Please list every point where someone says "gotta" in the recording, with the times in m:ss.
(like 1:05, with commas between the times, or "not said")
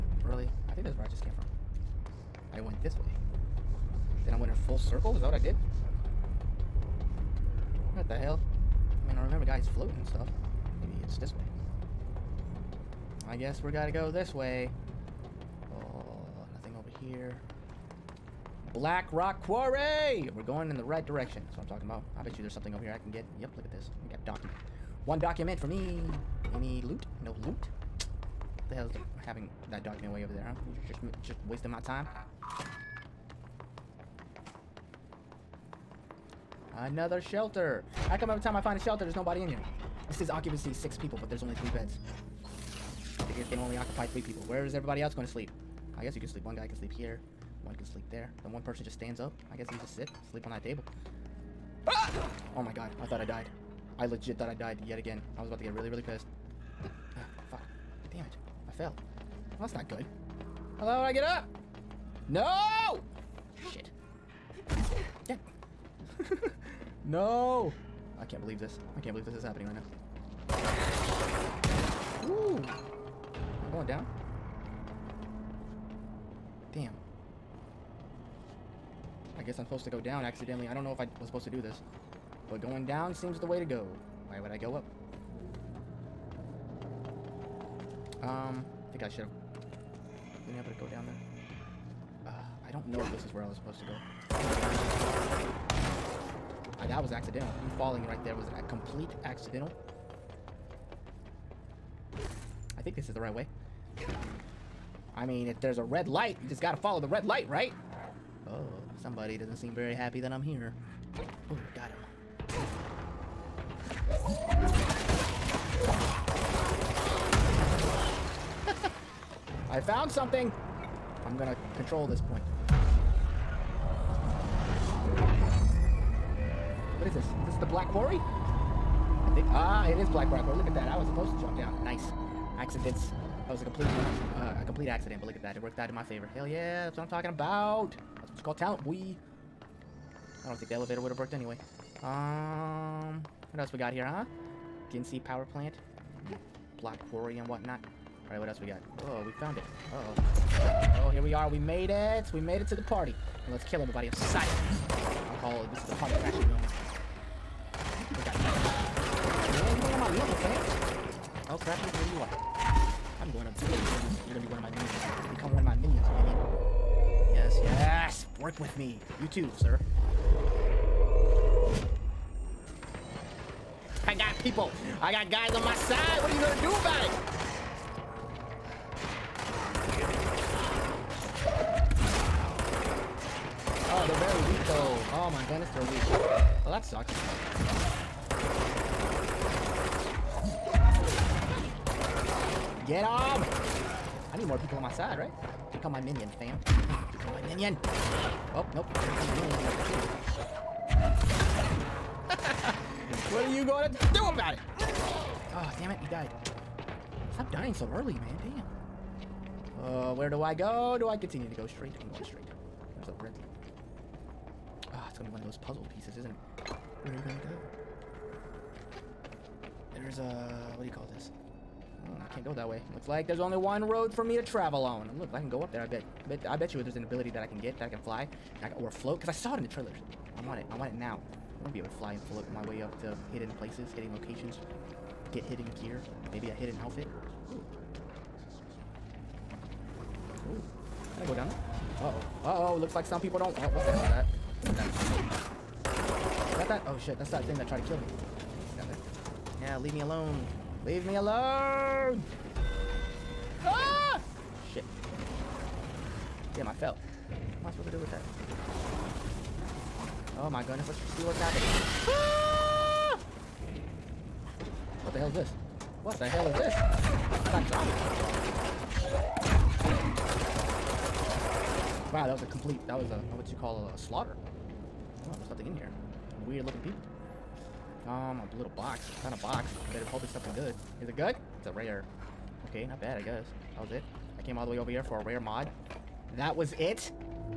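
0:13, 1:46.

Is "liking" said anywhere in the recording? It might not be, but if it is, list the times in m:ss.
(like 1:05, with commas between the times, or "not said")
not said.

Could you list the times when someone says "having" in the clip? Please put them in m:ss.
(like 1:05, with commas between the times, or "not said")
0:29.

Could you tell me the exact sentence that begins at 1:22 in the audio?
But going down seems the way to go.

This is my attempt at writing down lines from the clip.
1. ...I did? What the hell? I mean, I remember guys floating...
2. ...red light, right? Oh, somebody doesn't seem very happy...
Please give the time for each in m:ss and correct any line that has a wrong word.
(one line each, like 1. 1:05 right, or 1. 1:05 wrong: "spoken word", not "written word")
1. 0:05 right
2. 1:47 right.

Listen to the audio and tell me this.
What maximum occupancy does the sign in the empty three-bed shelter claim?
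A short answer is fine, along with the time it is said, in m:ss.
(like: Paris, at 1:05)
6, at 0:40.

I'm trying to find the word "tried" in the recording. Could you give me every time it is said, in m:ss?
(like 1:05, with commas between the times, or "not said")
4:07.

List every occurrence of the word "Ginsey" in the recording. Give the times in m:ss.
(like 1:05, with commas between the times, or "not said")
2:24.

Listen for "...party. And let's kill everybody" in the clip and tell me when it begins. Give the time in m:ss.
2:32.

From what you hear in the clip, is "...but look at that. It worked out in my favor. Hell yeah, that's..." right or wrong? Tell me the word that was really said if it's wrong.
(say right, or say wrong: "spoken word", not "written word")
right.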